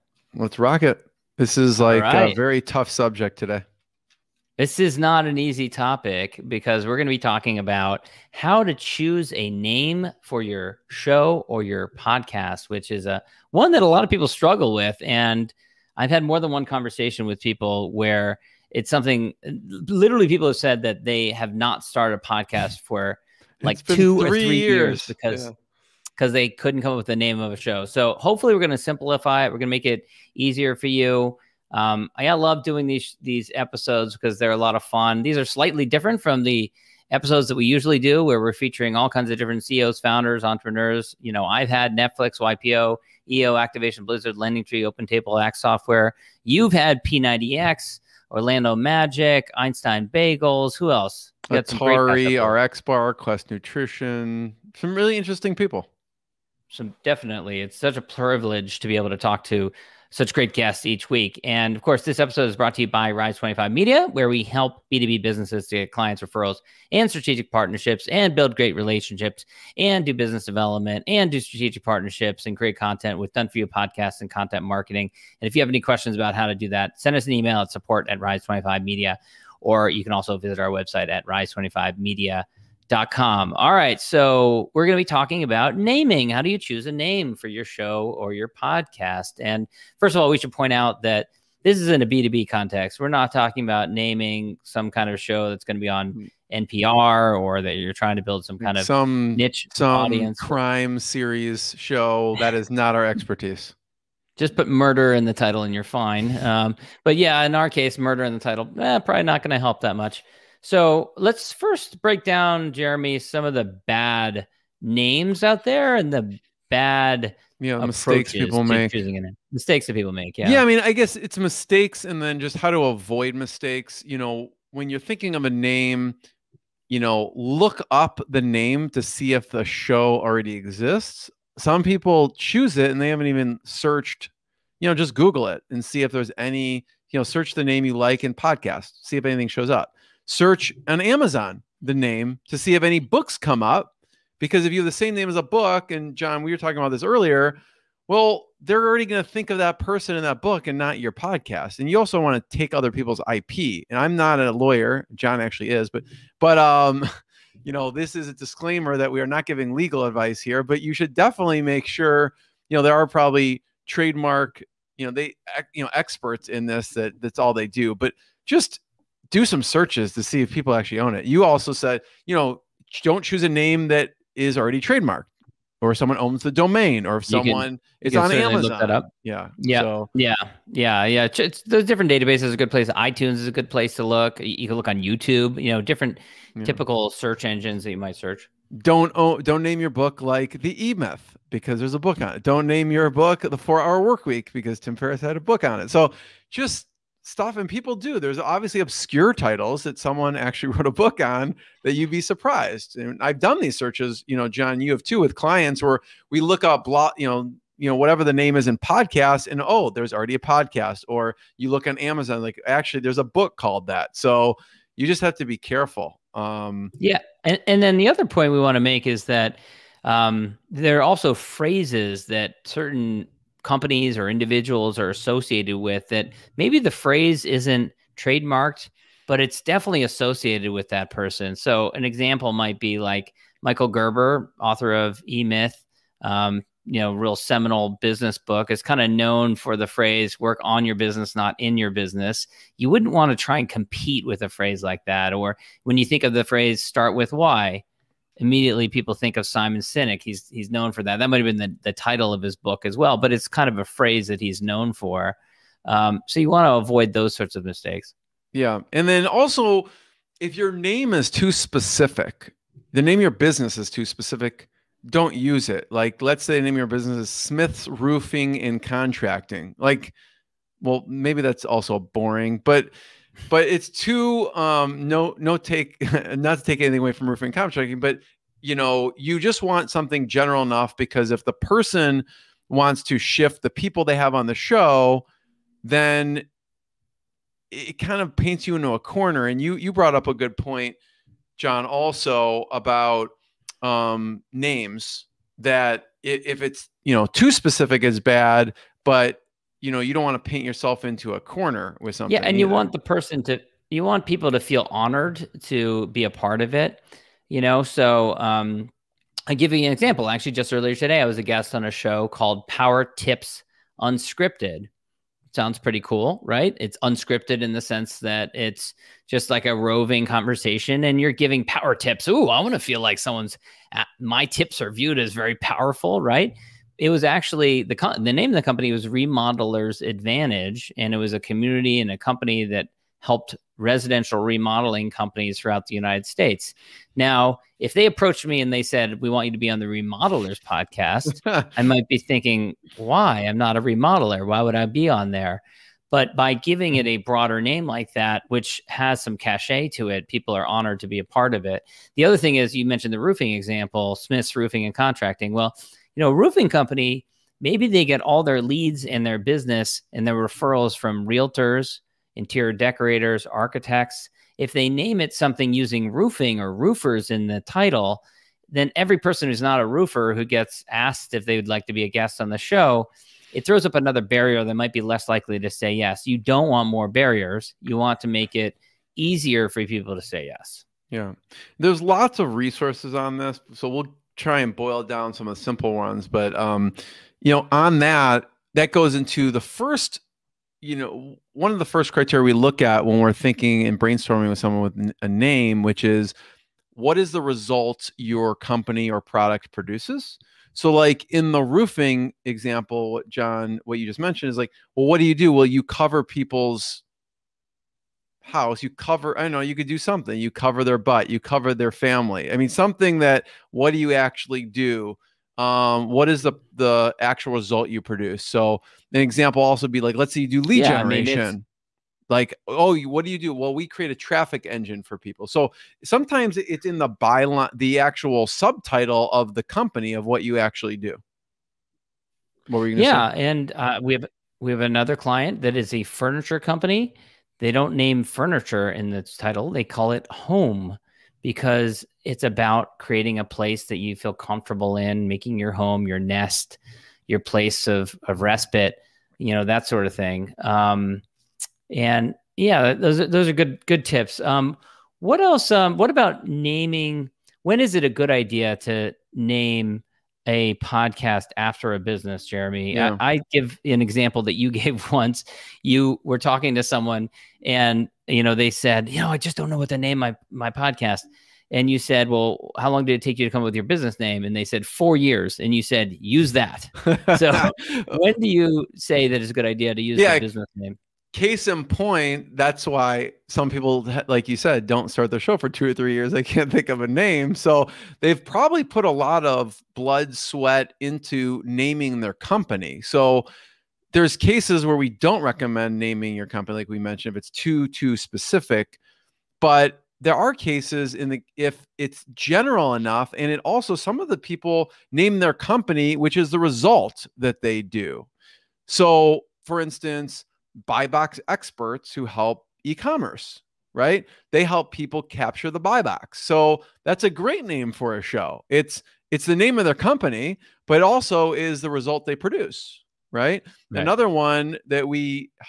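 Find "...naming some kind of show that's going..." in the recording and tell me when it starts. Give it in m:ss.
1:33.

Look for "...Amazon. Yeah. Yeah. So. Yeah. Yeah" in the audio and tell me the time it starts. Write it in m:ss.
2:58.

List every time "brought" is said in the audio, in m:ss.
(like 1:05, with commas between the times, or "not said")
1:02, 4:49.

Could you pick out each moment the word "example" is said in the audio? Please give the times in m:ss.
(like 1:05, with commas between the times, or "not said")
3:52, 5:09, 5:53, 6:42, 6:59, 7:44.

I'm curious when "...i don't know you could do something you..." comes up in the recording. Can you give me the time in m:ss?
6:49.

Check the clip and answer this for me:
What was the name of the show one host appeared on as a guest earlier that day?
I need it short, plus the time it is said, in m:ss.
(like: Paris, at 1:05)
Power Tips Unscripted, at 5:12.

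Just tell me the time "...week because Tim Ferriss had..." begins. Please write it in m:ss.
3:14.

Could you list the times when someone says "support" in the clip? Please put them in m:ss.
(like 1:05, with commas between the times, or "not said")
1:17.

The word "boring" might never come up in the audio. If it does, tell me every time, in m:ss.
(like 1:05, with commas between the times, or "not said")
4:31.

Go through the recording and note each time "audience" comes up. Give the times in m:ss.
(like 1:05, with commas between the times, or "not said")
1:40.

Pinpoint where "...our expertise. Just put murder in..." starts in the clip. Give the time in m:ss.
1:42.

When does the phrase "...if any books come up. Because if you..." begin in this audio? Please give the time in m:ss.
2:22.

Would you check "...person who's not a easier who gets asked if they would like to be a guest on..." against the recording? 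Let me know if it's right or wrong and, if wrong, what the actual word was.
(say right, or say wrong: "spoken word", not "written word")
wrong: "roofer", not "easier".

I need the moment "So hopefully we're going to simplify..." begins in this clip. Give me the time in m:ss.
0:27.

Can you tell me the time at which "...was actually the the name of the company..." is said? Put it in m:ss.
5:27.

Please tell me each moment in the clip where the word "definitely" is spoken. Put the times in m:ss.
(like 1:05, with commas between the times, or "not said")
0:57, 2:41, 3:49.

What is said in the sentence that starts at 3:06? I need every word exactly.
typical search engines that you might search.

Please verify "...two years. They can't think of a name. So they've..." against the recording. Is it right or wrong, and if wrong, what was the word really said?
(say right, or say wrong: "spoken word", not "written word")
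wrong: "three", not "two".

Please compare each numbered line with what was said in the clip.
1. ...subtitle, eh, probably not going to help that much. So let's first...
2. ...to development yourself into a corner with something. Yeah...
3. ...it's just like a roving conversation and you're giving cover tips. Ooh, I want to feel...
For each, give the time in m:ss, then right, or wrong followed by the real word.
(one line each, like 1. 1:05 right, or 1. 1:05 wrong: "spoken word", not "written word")
1. 1:48 wrong: "title", not "subtitle"
2. 5:00 wrong: "paint", not "development"
3. 5:18 wrong: "power", not "cover".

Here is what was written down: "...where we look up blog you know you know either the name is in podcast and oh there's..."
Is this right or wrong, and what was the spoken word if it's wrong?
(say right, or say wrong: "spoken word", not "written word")
wrong: "whatever", not "either".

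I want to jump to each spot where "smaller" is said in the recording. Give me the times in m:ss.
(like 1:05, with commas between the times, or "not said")
not said.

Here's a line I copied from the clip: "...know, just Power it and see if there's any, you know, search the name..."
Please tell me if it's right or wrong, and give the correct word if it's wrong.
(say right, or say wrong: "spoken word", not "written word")
wrong: "Google", not "Power".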